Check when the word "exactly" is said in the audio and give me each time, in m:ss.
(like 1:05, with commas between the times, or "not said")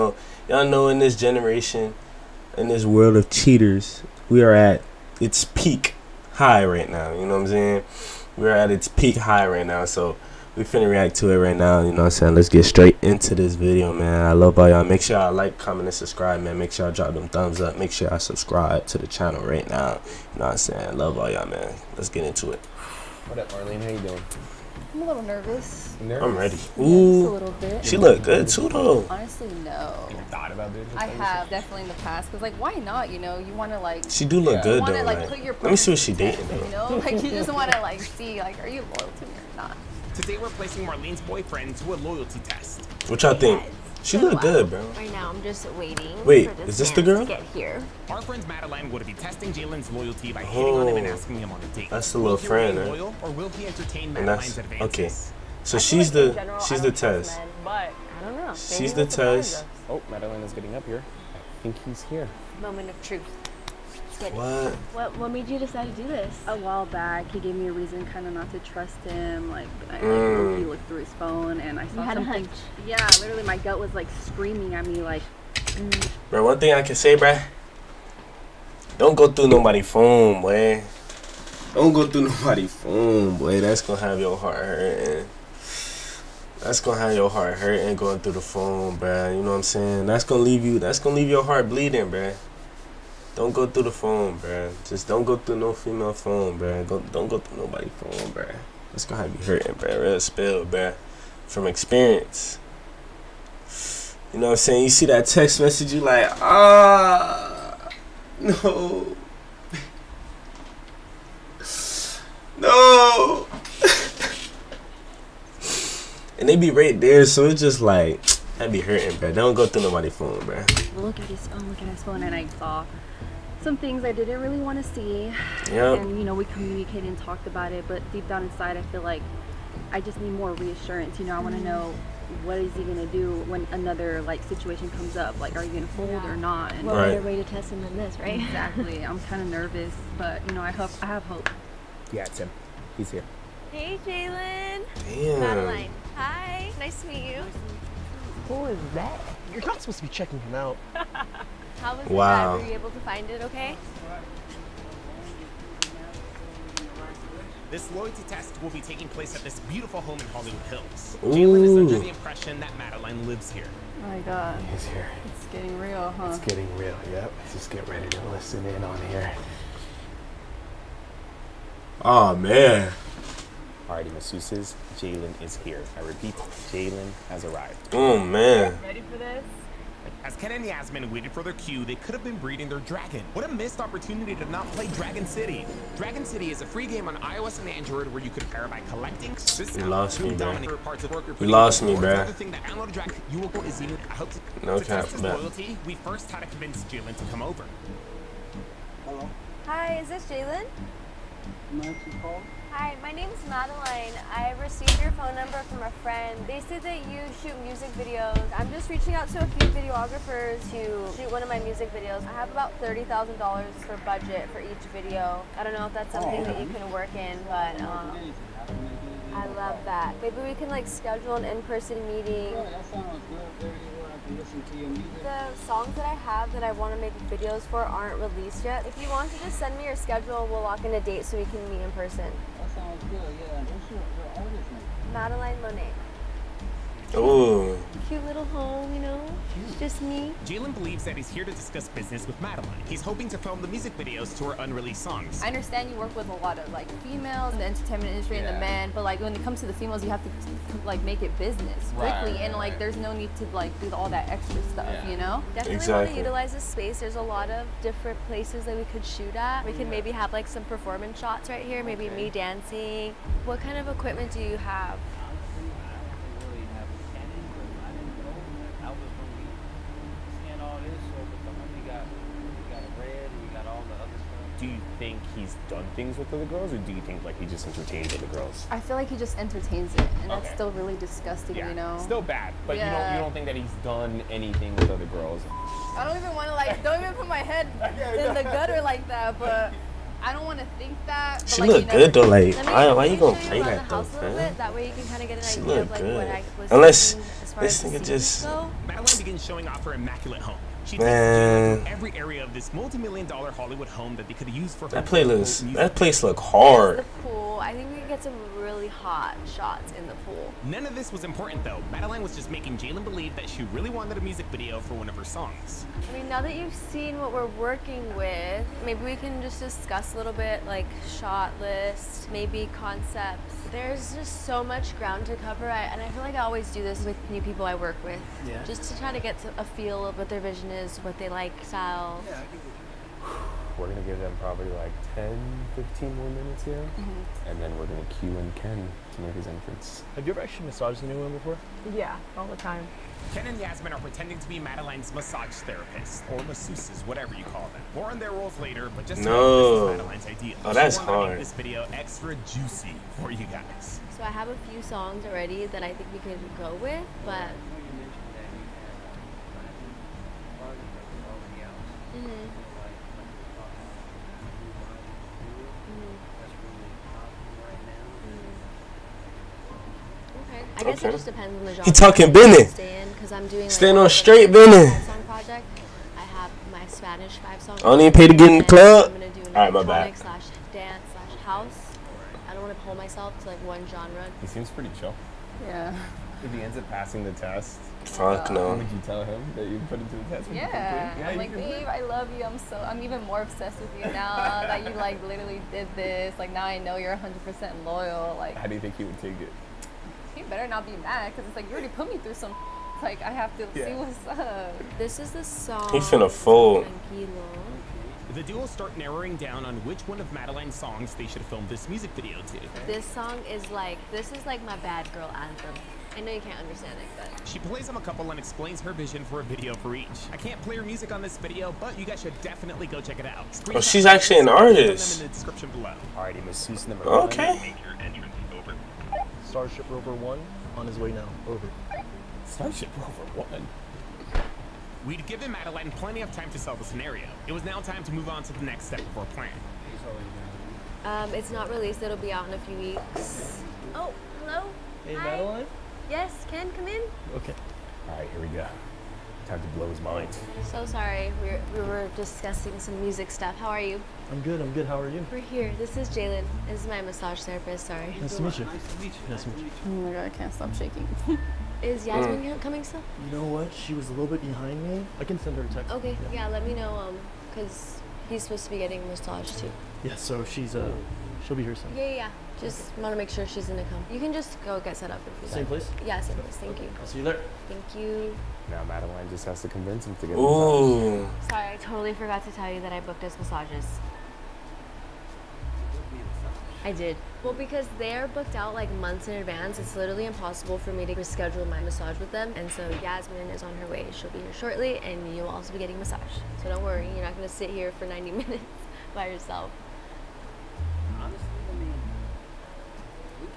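2:18, 4:15.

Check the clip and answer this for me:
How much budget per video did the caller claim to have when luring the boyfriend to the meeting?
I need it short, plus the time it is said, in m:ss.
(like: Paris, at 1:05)
$30,000, at 3:32.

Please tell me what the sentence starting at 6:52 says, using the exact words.
This song is like, this is like my bad girl anthem.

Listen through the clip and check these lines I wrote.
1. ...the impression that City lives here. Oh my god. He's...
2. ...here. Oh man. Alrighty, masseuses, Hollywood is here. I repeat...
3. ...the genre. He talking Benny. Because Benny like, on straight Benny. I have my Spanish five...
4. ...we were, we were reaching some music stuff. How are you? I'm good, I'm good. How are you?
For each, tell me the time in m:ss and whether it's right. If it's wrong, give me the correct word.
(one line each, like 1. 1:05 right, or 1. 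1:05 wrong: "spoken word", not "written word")
1. 2:41 wrong: "Madeline", not "City"
2. 2:49 wrong: "Jalen", not "Hollywood"
3. 6:11 wrong: "Stand", not "Benny"
4. 7:31 wrong: "discussing", not "reaching".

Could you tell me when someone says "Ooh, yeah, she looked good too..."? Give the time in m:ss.
0:26.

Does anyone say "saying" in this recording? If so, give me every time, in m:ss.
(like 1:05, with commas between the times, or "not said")
0:07, 0:12, 0:20, 1:29, 1:44.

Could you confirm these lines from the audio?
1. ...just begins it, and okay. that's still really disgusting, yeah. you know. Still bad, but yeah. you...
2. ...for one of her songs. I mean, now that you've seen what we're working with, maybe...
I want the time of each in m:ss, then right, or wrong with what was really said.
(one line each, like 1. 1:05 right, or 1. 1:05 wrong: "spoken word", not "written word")
1. 4:39 wrong: "entertains", not "begins"
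2. 5:14 right.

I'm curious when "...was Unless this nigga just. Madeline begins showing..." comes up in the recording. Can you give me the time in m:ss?
4:56.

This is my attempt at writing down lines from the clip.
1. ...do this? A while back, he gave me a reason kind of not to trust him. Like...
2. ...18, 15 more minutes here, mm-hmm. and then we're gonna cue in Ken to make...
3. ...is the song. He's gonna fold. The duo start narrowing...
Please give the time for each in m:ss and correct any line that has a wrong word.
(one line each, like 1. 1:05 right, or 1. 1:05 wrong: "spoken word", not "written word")
1. 1:06 right
2. 5:35 wrong: "10", not "18"
3. 6:45 right.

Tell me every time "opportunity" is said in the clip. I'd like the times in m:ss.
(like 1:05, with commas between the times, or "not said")
3:03.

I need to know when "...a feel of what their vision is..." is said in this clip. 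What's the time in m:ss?
5:29.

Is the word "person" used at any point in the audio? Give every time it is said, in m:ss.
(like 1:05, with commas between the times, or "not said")
3:41, 3:51.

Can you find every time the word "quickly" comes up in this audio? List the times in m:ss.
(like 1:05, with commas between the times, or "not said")
4:11.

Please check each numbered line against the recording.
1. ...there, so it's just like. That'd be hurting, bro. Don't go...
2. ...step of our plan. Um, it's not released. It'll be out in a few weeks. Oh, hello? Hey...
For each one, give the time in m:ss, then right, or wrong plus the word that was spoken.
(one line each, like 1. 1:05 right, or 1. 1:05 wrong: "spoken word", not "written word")
1. 1:57 right
2. 7:18 right.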